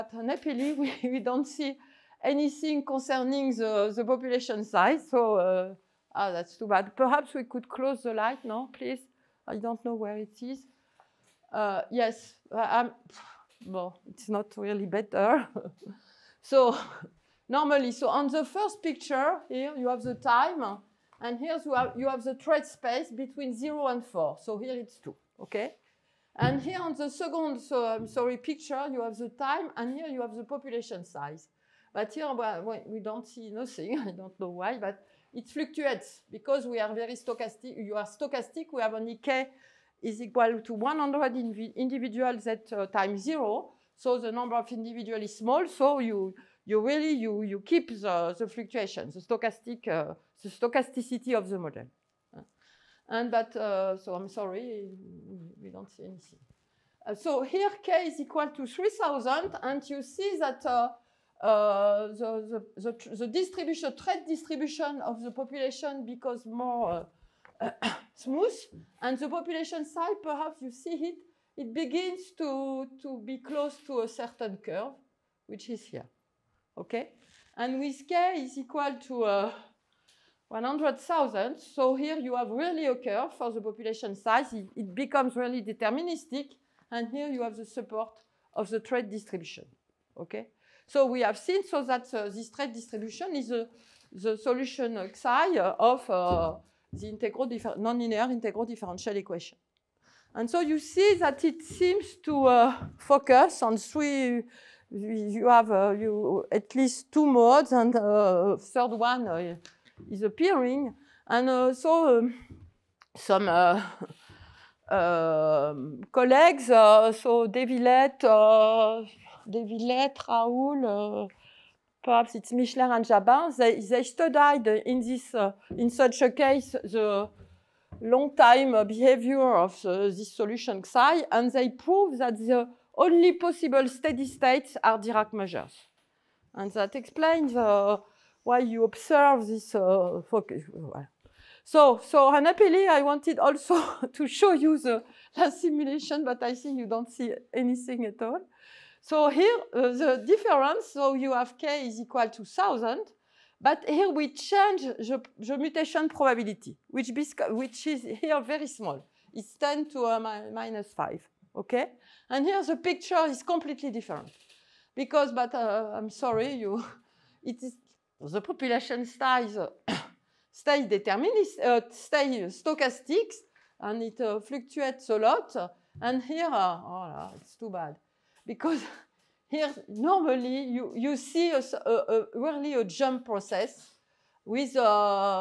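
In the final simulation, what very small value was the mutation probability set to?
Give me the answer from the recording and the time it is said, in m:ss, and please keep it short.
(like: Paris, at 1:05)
10^-5, at 2:39.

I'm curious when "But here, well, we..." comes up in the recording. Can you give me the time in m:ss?
0:31.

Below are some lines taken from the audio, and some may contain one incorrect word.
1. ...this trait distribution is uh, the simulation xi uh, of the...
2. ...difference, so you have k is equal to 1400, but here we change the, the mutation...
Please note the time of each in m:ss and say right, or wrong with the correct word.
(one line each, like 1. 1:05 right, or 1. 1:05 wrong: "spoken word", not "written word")
1. 1:32 wrong: "solution", not "simulation"
2. 2:30 wrong: "1000", not "1400".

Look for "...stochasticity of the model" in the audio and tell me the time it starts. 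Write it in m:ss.
0:50.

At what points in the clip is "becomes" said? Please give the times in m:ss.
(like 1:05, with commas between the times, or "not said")
1:06, 1:24.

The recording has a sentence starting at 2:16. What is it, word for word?
And that explains uh, why you observe this uh, focus.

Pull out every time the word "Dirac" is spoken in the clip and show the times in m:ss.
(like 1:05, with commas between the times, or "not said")
2:14.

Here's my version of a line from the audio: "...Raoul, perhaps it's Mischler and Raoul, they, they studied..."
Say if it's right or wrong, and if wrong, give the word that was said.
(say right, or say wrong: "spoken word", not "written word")
wrong: "Jabin", not "Raoul".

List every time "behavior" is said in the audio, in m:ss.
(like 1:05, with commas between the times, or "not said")
2:08.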